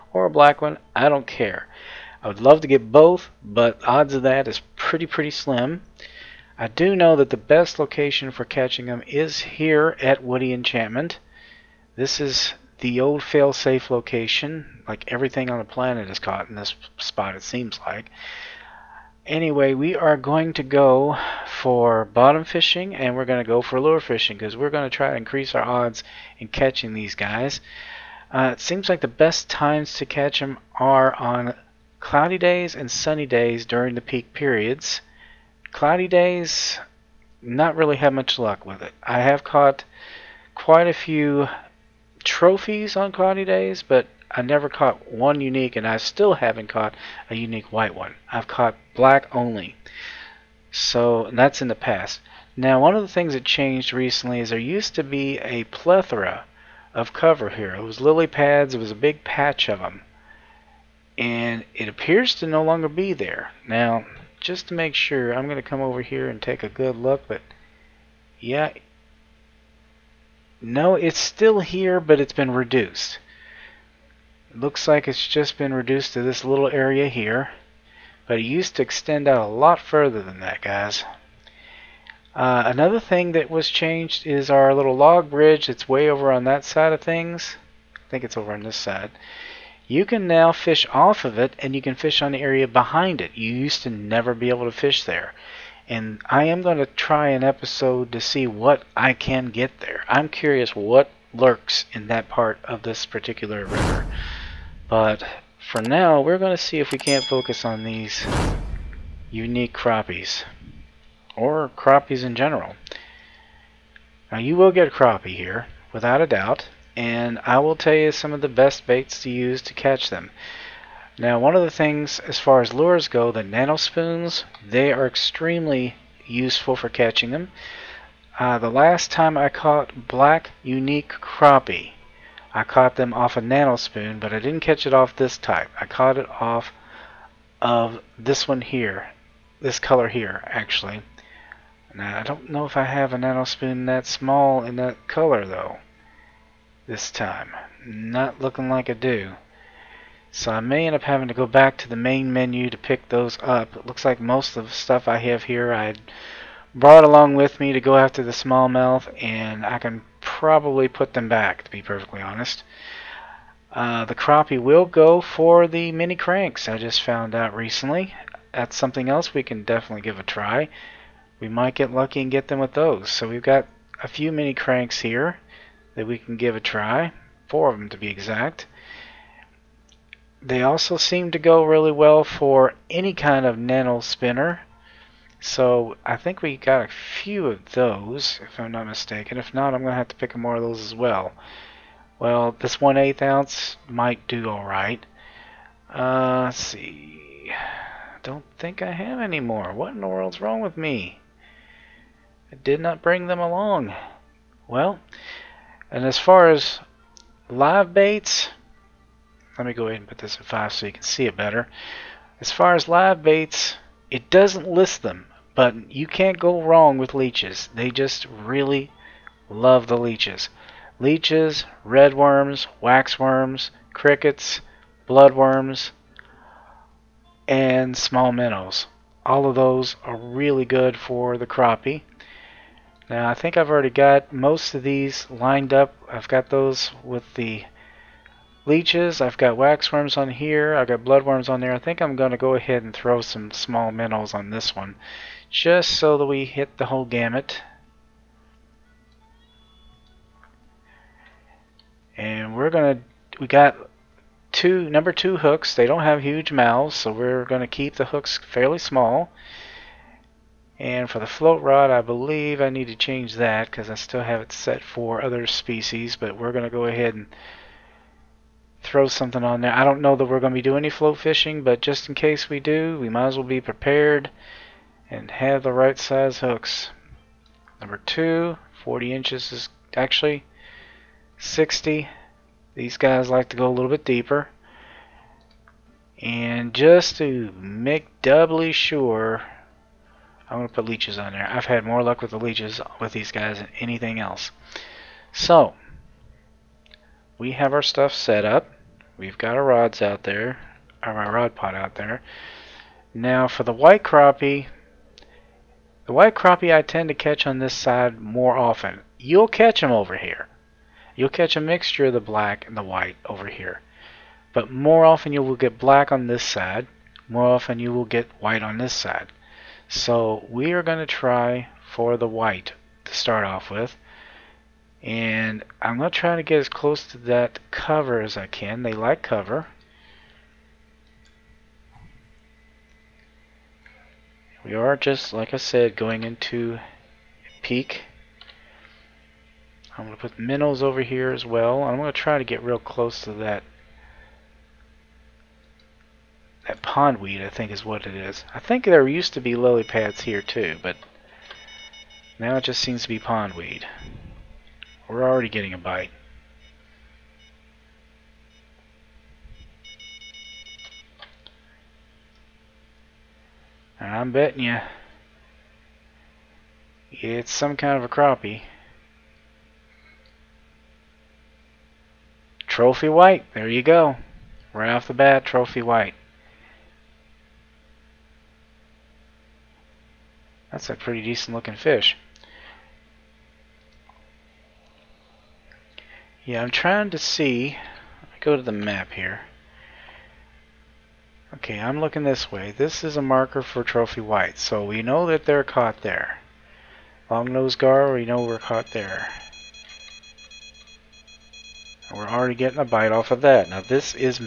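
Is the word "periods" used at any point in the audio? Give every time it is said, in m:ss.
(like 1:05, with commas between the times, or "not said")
0:34.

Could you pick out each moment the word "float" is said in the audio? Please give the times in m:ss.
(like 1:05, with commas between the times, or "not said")
4:21, 4:30.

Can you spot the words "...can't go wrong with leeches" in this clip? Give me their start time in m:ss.
3:36.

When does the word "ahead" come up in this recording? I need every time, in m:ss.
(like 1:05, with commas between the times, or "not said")
3:29, 4:02, 4:26.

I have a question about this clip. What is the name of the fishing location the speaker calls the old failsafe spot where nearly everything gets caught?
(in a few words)
Woody Enchantment.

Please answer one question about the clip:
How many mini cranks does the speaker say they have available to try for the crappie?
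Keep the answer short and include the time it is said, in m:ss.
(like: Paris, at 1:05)
4, at 2:57.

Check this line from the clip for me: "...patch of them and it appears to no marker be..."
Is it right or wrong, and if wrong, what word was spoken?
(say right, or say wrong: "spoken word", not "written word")
wrong: "longer", not "marker".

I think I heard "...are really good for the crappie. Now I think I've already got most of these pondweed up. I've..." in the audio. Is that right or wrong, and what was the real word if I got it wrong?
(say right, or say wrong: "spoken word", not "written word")
wrong: "lined", not "pondweed".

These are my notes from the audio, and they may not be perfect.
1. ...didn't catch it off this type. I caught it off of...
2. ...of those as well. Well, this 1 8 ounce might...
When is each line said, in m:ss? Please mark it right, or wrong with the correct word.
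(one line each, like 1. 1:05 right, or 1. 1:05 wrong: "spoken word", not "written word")
1. 2:14 right
2. 3:10 right.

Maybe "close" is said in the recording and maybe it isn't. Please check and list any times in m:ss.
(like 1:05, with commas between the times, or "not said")
5:26, 5:42.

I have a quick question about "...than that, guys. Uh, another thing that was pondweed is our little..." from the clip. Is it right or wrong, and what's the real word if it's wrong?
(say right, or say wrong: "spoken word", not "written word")
wrong: "changed", not "pondweed".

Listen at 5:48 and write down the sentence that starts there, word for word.
I think there used to be lily pads here too, but now it just seems to be pondweed.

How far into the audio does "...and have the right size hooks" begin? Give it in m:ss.
4:35.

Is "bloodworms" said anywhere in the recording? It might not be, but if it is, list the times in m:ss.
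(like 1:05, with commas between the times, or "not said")
3:45, 4:00.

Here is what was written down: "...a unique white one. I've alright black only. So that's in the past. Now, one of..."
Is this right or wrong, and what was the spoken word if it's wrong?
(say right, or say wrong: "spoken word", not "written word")
wrong: "caught", not "alright".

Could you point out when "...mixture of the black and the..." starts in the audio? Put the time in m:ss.
5:11.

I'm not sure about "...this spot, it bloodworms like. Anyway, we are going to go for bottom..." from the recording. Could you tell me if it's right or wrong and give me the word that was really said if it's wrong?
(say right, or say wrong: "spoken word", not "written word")
wrong: "seems", not "bloodworms".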